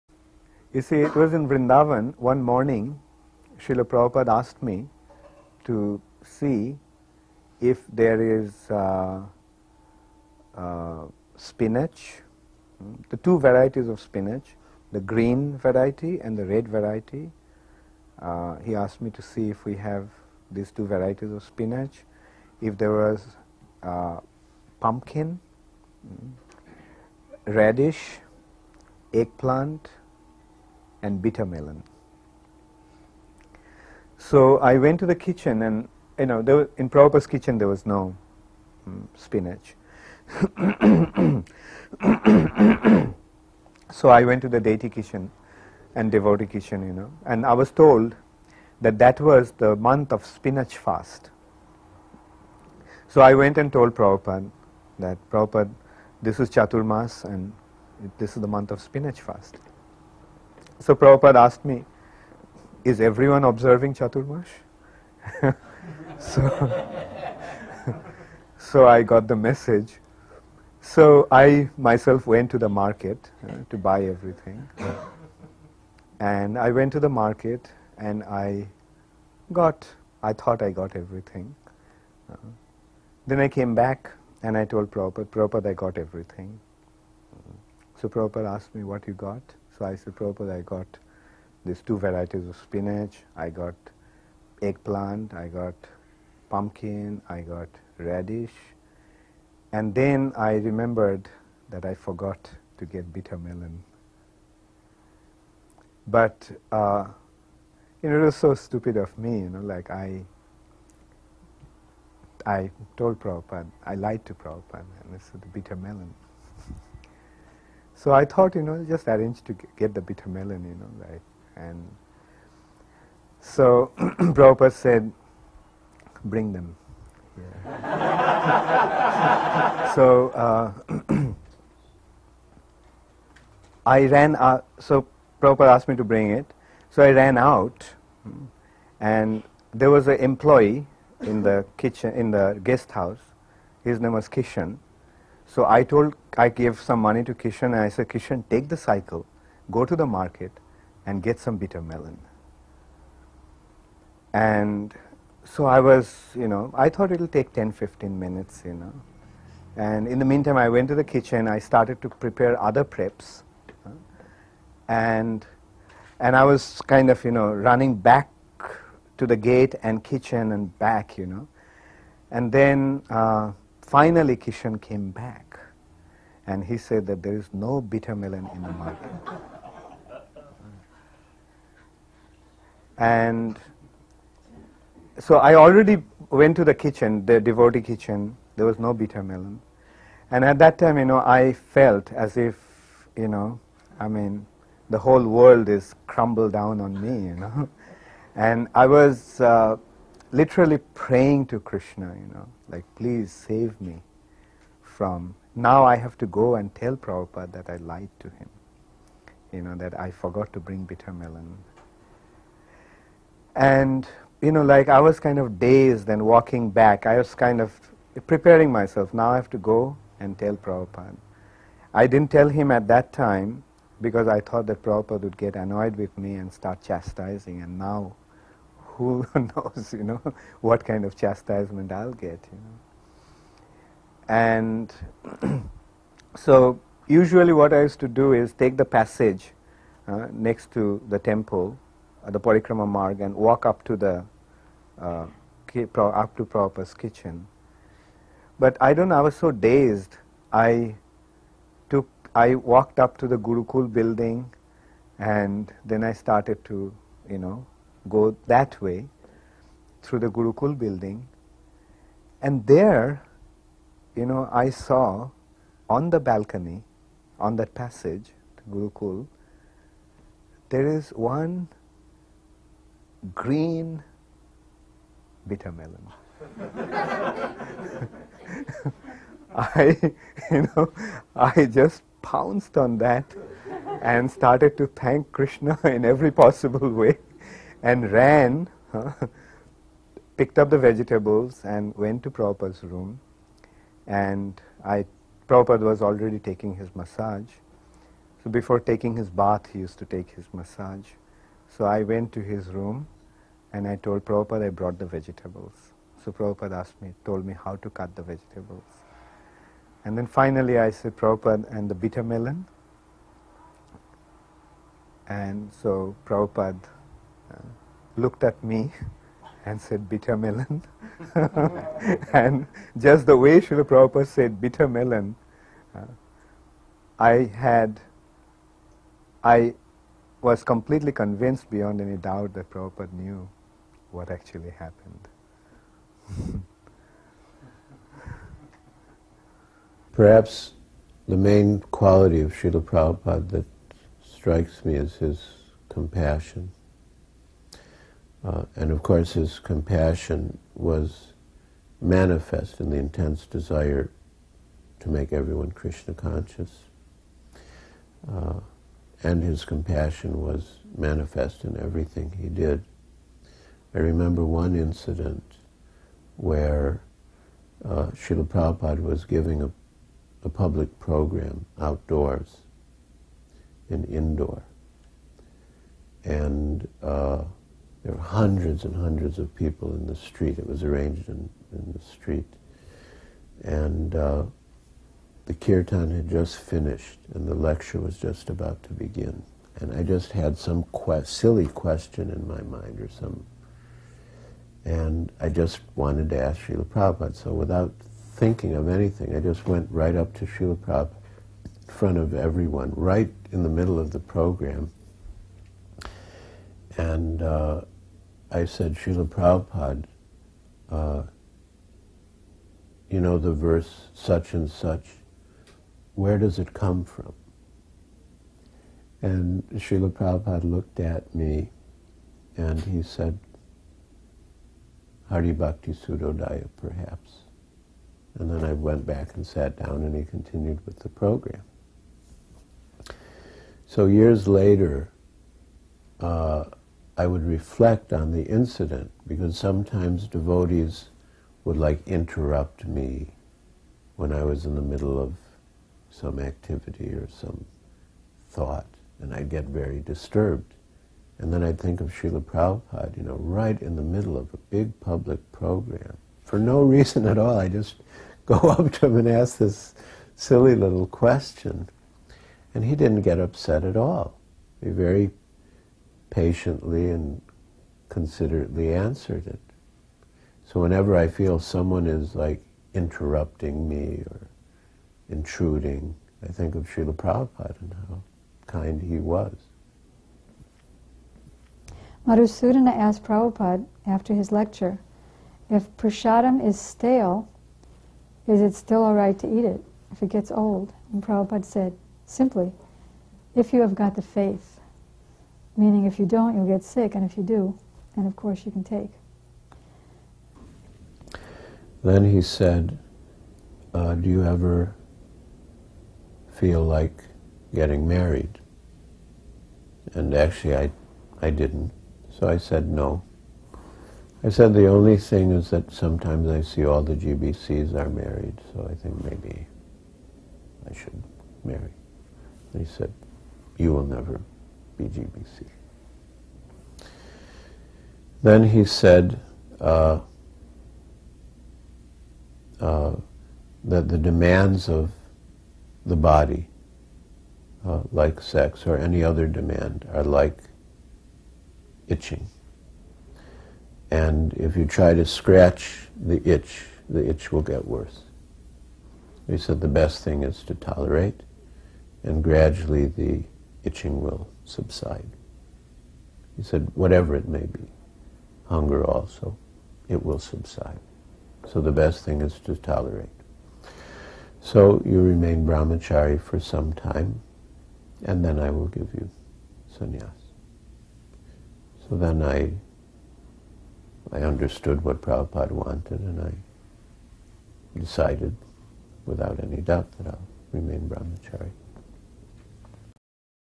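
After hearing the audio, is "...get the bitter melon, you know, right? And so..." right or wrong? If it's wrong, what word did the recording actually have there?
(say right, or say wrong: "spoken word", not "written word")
right.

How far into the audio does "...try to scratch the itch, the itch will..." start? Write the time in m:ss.
9:04.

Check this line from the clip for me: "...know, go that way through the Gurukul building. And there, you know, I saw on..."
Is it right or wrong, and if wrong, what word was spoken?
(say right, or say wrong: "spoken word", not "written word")
right.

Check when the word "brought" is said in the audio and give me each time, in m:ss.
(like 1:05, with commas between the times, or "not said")
5:04.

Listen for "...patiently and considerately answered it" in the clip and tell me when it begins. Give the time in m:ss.
7:46.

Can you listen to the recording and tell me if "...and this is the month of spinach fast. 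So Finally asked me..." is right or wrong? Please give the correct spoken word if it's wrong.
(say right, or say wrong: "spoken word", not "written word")
wrong: "Prabhupada", not "Finally".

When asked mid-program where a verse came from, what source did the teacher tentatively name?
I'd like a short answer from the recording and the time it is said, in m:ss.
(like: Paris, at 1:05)
Hari Bhakti Sudhodaya, at 7:05.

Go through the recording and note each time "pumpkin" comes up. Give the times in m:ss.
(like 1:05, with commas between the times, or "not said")
0:24, 1:36.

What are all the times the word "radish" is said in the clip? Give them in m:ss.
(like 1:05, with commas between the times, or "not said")
0:27, 1:37.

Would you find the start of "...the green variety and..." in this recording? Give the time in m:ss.
0:14.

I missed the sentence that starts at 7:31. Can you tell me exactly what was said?
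And then I'd think of Srila Prabhupada, you know, right in the middle of a big public program.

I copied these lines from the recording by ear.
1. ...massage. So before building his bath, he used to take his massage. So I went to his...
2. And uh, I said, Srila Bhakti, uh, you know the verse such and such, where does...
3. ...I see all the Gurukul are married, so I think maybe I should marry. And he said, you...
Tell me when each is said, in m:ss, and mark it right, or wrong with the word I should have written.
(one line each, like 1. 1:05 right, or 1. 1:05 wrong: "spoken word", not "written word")
1. 4:56 wrong: "taking", not "building"
2. 6:46 wrong: "Prabhupada", not "Bhakti"
3. 8:36 wrong: "GBCs", not "Gurukul".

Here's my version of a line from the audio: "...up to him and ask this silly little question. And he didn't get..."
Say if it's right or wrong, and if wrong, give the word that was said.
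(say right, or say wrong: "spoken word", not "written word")
right.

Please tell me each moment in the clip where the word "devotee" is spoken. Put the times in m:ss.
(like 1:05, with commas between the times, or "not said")
0:46, 3:07, 7:20.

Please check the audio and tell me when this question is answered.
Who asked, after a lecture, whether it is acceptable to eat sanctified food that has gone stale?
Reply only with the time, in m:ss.
8:02.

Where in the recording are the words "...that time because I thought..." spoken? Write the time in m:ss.
3:42.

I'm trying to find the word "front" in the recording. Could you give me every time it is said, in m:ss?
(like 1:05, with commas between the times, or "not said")
6:41.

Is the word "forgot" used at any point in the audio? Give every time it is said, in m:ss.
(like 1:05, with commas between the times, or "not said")
1:41, 3:30.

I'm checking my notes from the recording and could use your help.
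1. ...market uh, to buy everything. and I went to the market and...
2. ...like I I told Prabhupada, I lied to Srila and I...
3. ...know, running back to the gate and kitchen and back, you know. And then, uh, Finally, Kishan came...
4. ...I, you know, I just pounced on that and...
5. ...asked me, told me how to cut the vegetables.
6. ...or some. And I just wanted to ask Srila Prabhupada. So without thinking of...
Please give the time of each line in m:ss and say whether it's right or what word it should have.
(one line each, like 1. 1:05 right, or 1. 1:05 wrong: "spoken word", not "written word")
1. 1:12 right
2. 1:49 wrong: "Prabhupada", not "Srila"
3. 2:47 right
4. 4:39 right
5. 5:06 right
6. 6:32 right.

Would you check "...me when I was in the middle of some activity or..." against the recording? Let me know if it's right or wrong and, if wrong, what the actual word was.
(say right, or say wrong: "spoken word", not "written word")
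right.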